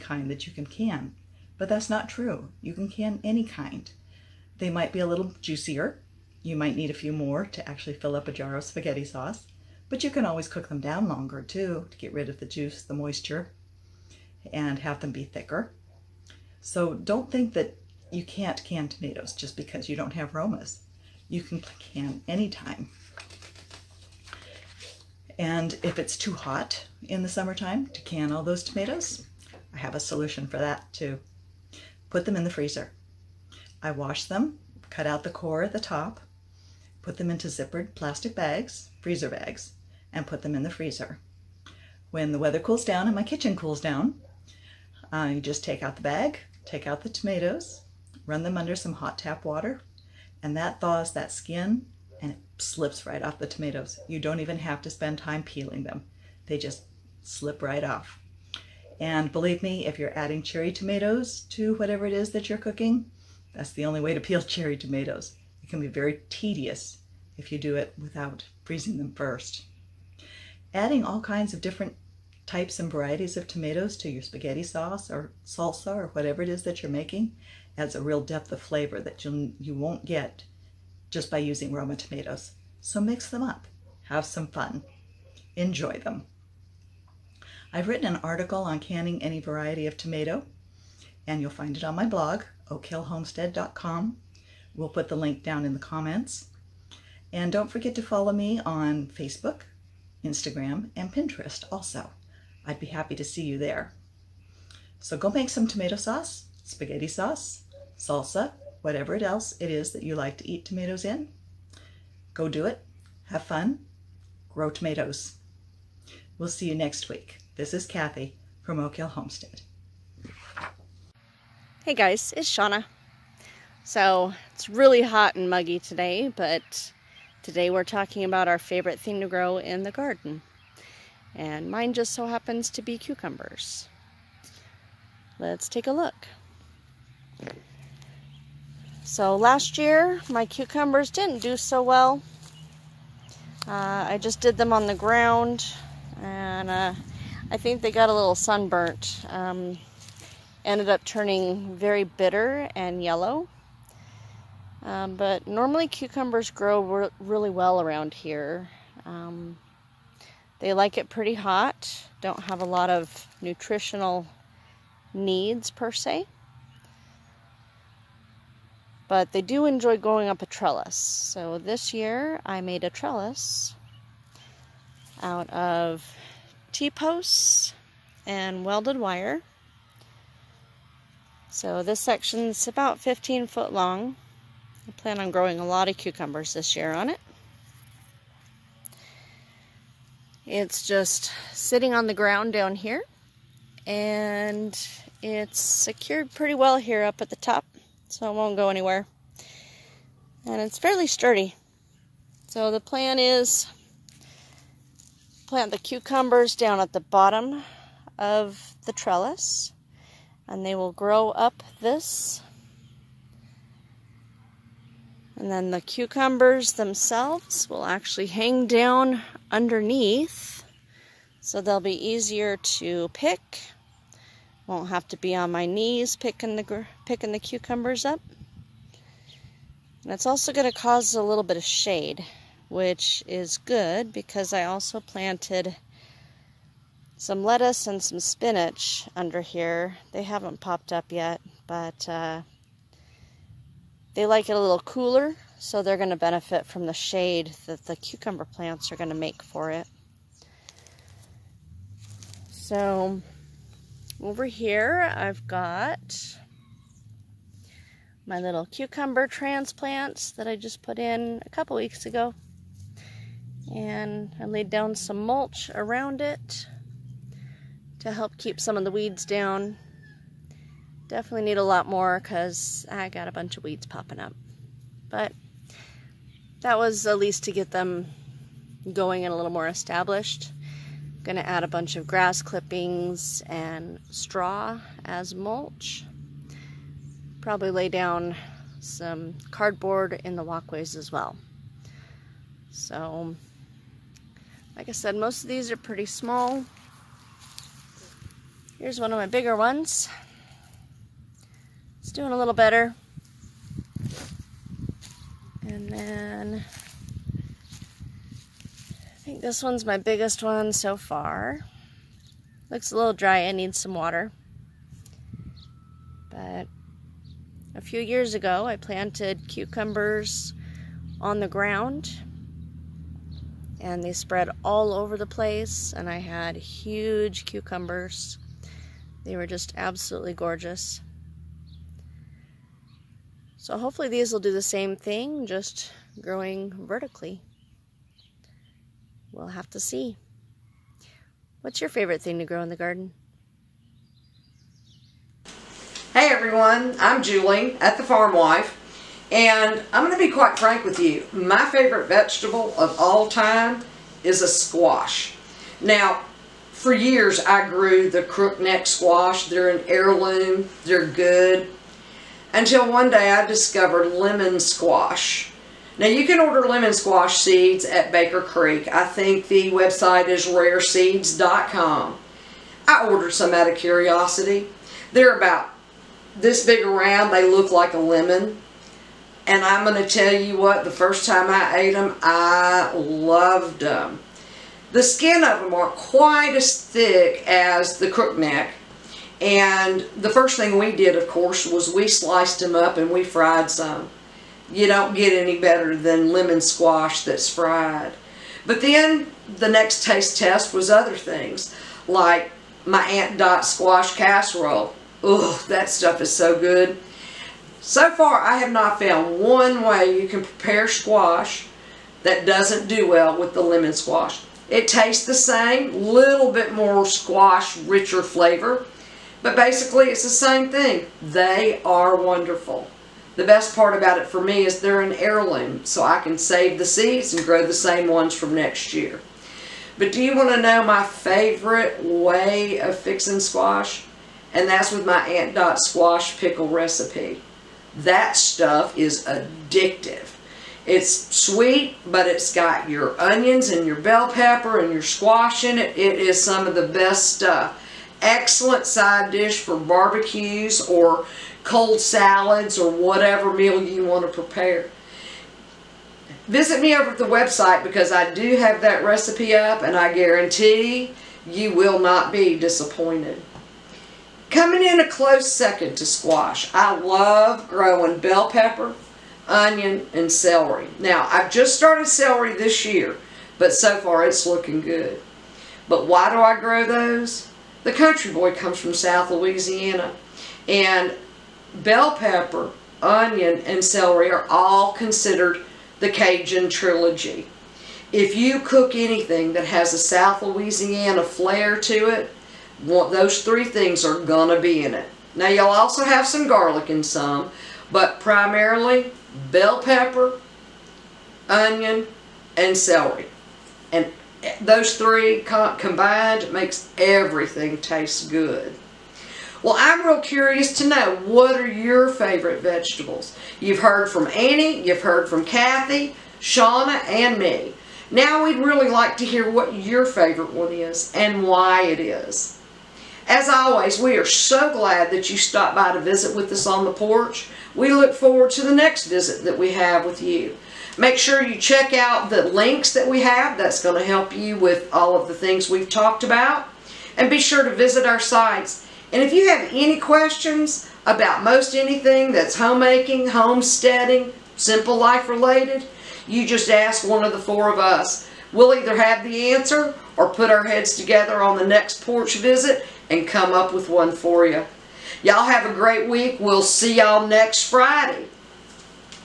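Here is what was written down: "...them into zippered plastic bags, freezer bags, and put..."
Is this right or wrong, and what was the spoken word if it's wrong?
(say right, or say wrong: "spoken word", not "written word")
right.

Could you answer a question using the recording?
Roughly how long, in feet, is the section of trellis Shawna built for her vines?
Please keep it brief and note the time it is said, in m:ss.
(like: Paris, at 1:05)
15 feet, at 3:02.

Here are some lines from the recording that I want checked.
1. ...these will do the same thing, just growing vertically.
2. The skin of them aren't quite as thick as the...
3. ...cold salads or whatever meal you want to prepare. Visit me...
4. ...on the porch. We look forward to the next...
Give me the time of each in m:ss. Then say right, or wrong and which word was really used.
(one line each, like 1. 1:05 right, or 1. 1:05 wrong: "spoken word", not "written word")
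1. 5:34 right
2. 6:24 right
3. 7:31 right
4. 8:46 right.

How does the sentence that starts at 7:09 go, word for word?
But do you want to know my favorite way of fixing squash?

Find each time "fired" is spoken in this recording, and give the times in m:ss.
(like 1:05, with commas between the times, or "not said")
not said.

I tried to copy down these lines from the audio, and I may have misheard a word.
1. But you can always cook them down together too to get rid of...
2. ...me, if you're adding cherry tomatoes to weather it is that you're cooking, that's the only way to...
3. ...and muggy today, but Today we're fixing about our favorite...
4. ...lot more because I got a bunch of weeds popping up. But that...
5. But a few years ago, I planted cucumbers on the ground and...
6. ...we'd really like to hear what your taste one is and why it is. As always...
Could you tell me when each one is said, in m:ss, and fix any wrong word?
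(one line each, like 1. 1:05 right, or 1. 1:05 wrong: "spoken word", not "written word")
1. 0:09 wrong: "longer", not "together"
2. 0:59 wrong: "whatever", not "weather"
3. 2:05 wrong: "talking", not "fixing"
4. 4:31 right
5. 5:16 right
6. 8:38 wrong: "favorite", not "taste".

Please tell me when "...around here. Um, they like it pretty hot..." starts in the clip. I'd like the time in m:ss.
2:37.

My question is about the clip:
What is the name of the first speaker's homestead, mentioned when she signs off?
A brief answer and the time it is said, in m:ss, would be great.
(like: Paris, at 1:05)
Oak Hill Homestead, at 1:58.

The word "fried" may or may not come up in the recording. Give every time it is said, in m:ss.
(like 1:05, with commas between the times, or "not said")
6:33, 6:37.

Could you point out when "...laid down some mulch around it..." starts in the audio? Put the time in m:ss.
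4:24.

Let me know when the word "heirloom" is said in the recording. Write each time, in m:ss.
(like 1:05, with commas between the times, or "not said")
5:59, 7:05.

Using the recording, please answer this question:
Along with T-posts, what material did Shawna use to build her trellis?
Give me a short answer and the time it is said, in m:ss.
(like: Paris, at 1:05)
Welded wire, at 2:58.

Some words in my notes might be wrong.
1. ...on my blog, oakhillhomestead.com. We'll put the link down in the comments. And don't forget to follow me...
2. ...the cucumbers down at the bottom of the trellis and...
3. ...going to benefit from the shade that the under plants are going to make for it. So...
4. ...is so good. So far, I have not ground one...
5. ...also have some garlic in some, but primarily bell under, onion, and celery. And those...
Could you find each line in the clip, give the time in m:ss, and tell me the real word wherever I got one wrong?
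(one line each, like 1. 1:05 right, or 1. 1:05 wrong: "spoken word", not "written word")
1. 1:31 right
2. 3:25 right
3. 4:05 wrong: "cucumber", not "under"
4. 6:46 wrong: "found", not "ground"
5. 8:15 wrong: "pepper", not "under".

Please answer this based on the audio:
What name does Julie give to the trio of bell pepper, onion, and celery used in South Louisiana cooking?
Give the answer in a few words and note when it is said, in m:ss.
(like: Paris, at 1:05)
Cajun trilogy, at 8:06.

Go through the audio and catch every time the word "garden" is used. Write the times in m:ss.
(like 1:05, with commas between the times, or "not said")
2:09, 5:42.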